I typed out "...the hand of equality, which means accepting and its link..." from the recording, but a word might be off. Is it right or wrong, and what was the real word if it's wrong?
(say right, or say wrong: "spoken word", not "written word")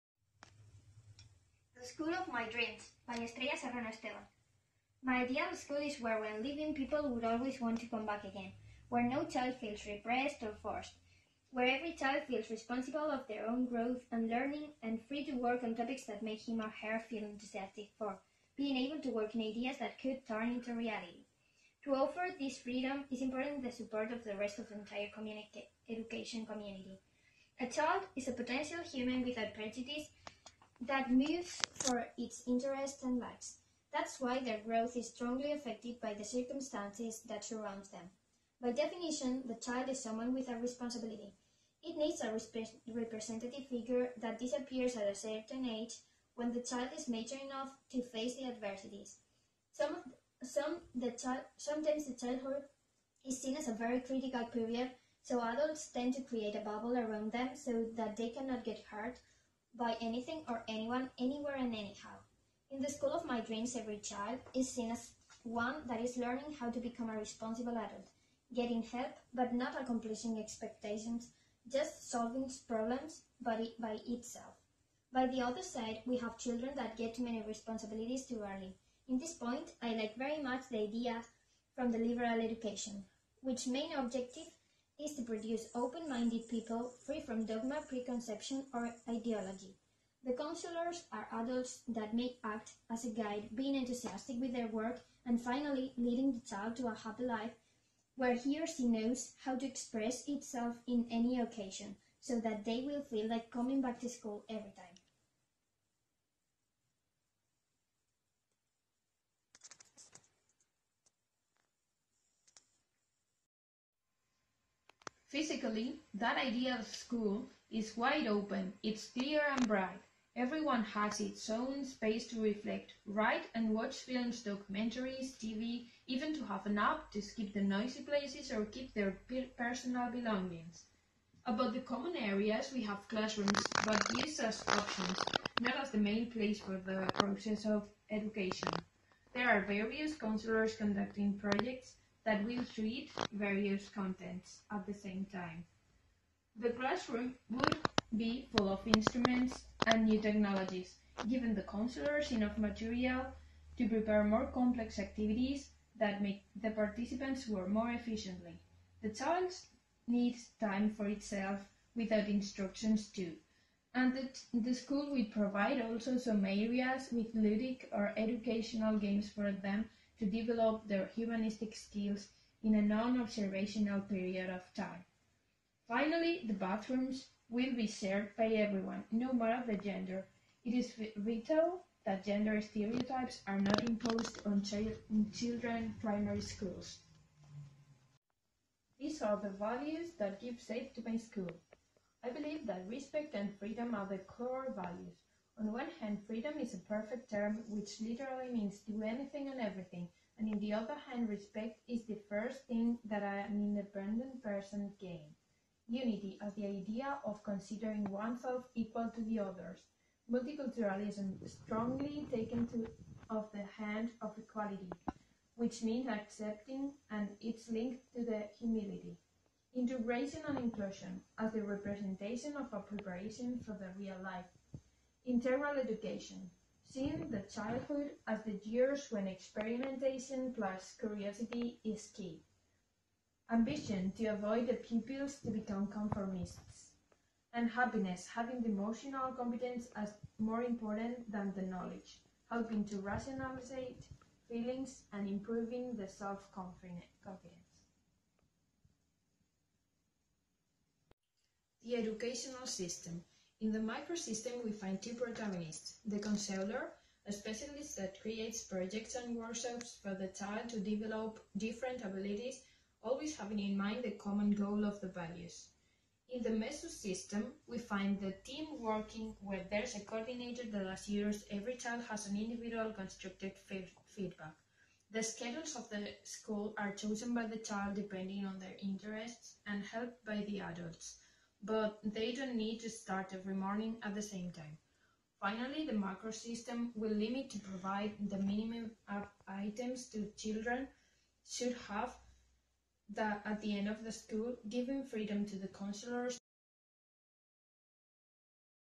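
right.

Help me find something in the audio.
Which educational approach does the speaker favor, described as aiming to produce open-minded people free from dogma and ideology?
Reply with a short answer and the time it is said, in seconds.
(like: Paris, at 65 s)
liberal education, at 81 s.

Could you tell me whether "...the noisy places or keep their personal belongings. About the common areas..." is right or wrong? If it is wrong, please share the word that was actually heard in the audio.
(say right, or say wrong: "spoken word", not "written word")
right.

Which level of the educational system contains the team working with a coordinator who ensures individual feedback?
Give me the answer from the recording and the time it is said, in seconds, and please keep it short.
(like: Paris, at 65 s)
mesosystem, at 266 s.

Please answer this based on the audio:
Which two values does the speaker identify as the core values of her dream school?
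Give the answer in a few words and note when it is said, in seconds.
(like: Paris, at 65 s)
respect and freedom, at 192 s.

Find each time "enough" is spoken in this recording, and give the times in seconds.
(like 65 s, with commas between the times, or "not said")
47 s, 152 s.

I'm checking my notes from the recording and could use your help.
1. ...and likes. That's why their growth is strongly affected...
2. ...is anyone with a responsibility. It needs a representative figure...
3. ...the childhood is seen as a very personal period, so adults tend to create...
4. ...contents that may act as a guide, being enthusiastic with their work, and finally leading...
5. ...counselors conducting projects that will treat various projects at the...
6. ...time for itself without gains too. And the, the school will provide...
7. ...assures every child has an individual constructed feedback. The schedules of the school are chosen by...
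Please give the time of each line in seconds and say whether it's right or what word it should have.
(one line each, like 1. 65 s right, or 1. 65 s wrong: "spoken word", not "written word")
1. 33 s right
2. 39 s wrong: "someone", not "anyone"
3. 52 s wrong: "critical", not "personal"
4. 91 s wrong: "adults", not "contents"
5. 140 s wrong: "contents", not "projects"
6. 160 s wrong: "instructions", not "gains"
7. 270 s right.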